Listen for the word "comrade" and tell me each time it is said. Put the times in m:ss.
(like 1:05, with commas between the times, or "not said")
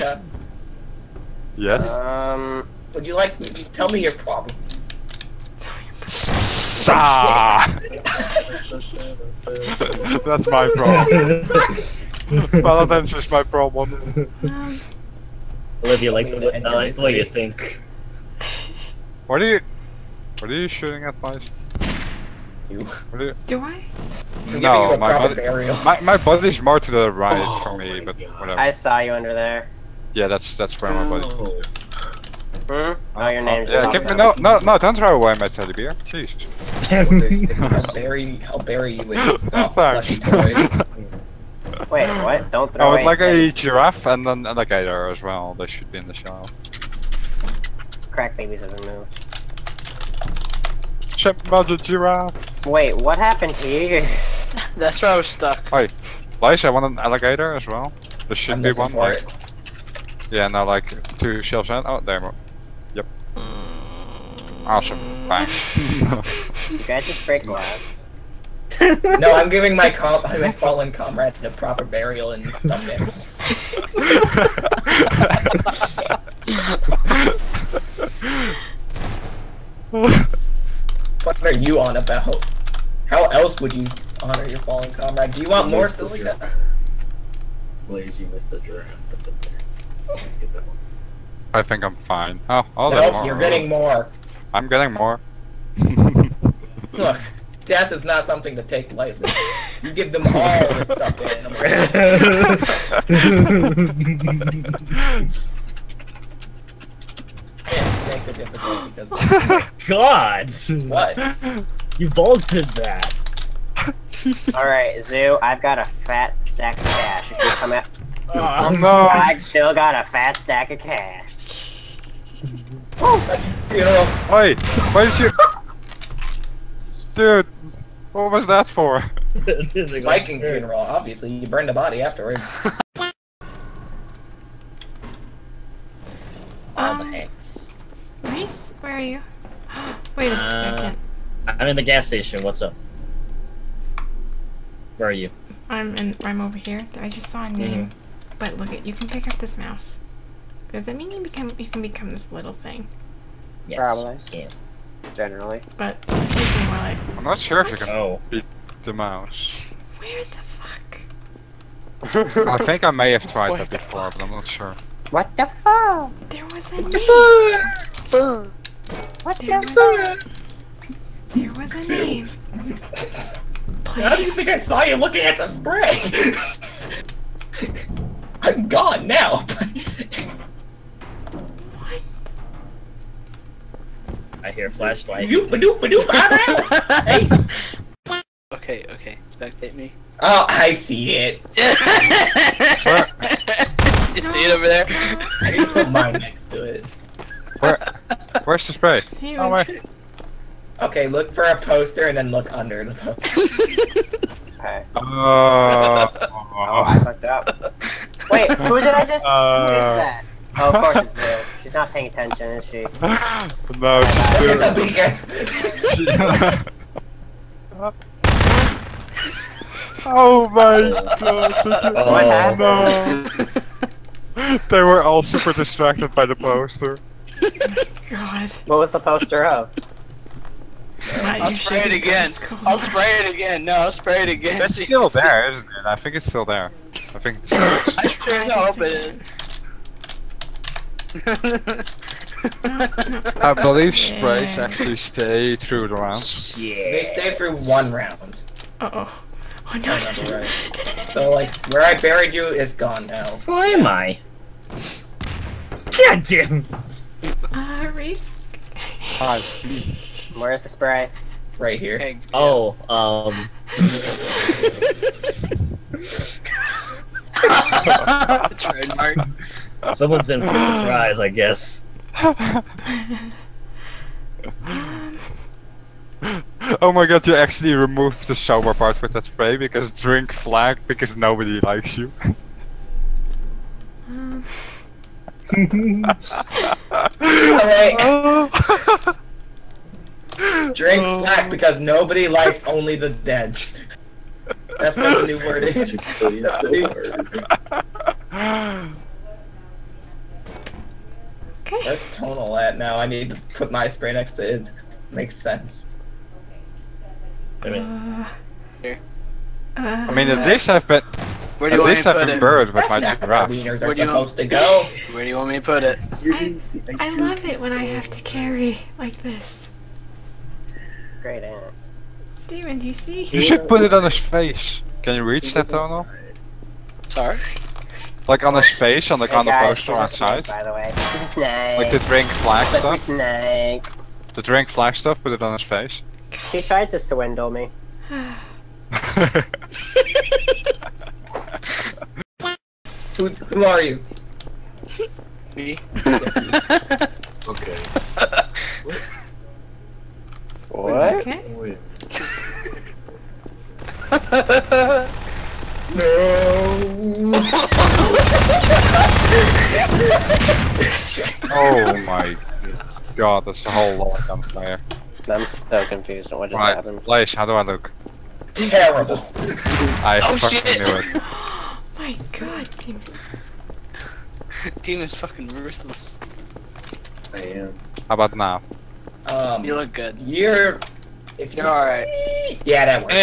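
1:10, 1:24.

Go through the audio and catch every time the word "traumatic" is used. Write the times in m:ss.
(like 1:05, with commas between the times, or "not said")
not said.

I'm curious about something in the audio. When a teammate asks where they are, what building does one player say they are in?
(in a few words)
Gas station.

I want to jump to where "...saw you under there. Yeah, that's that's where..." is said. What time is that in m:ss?
0:28.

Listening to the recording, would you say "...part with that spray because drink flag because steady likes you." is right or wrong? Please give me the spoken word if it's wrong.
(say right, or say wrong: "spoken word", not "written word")
wrong: "nobody", not "steady".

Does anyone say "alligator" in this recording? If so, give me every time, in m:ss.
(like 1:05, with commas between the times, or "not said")
0:44, 0:56.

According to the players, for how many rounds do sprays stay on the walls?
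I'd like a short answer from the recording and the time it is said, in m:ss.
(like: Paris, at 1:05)
1, at 4:07.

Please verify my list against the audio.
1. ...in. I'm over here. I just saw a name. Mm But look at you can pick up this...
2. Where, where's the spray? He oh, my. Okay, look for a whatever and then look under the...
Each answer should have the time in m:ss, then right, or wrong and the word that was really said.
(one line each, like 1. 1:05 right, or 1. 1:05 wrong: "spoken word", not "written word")
1. 2:25 right
2. 3:17 wrong: "poster", not "whatever".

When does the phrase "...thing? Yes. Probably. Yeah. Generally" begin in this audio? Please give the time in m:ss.
2:32.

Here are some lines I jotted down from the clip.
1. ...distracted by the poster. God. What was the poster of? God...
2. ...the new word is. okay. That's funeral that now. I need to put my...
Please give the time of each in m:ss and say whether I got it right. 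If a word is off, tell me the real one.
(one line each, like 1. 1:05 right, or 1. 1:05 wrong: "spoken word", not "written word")
1. 3:45 right
2. 4:55 wrong: "tonal", not "funeral".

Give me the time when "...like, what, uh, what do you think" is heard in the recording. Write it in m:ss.
0:16.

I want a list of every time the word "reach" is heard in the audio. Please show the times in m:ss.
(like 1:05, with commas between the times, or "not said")
5:25.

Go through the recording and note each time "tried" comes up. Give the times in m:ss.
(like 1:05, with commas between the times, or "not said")
2:43, 5:36.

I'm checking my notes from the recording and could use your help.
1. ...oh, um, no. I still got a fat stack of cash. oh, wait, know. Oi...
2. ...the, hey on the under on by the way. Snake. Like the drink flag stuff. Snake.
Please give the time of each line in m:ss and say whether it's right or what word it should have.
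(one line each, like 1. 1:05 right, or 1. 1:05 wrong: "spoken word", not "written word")
1. 1:58 right
2. 5:29 wrong: "poster", not "under".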